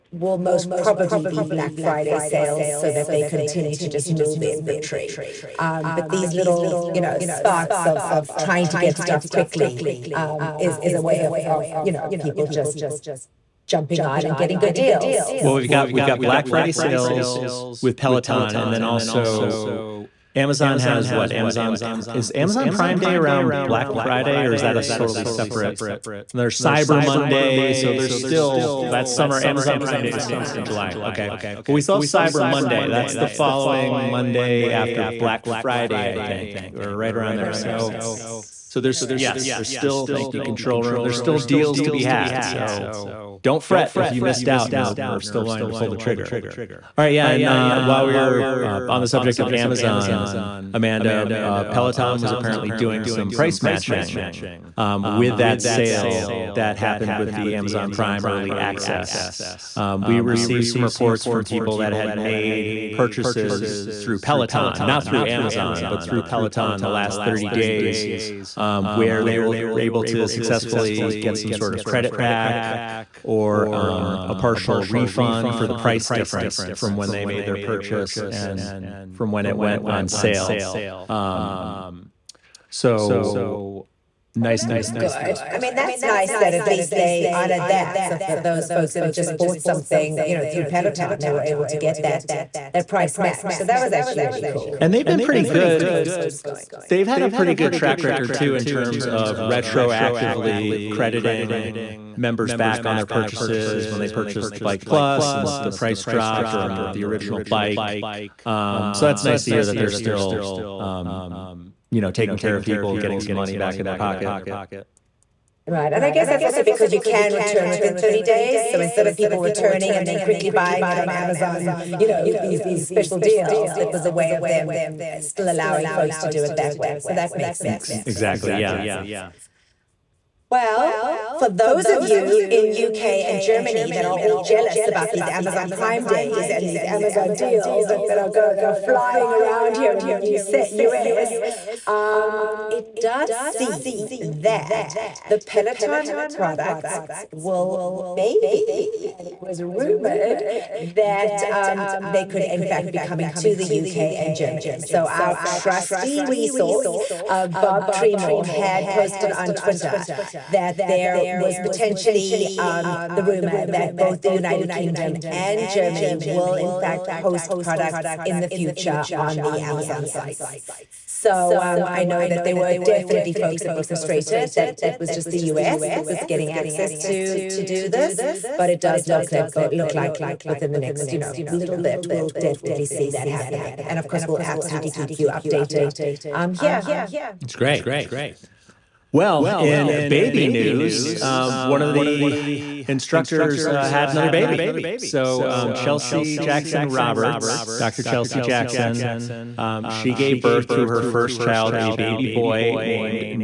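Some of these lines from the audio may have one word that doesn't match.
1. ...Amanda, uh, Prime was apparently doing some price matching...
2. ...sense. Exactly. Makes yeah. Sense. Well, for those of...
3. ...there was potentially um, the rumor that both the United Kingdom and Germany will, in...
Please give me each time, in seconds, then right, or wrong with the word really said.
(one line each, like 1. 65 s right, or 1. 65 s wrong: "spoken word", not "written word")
1. 50 s wrong: "Peloton", not "Prime"
2. 127 s right
3. 160 s right.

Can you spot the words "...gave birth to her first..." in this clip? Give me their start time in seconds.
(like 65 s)
200 s.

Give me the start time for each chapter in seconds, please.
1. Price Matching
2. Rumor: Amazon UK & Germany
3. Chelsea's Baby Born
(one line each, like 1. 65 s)
1. 45 s
2. 123 s
3. 187 s.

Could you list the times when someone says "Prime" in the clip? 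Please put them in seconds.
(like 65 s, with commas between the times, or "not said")
22 s, 29 s, 57 s, 135 s.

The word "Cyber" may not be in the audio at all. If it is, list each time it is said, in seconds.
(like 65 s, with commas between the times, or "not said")
26 s, 32 s.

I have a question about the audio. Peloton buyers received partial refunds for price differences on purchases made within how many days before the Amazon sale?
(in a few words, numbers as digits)
30 days.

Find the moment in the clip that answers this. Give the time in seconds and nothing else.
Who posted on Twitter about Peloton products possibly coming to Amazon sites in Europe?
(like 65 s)
157 s.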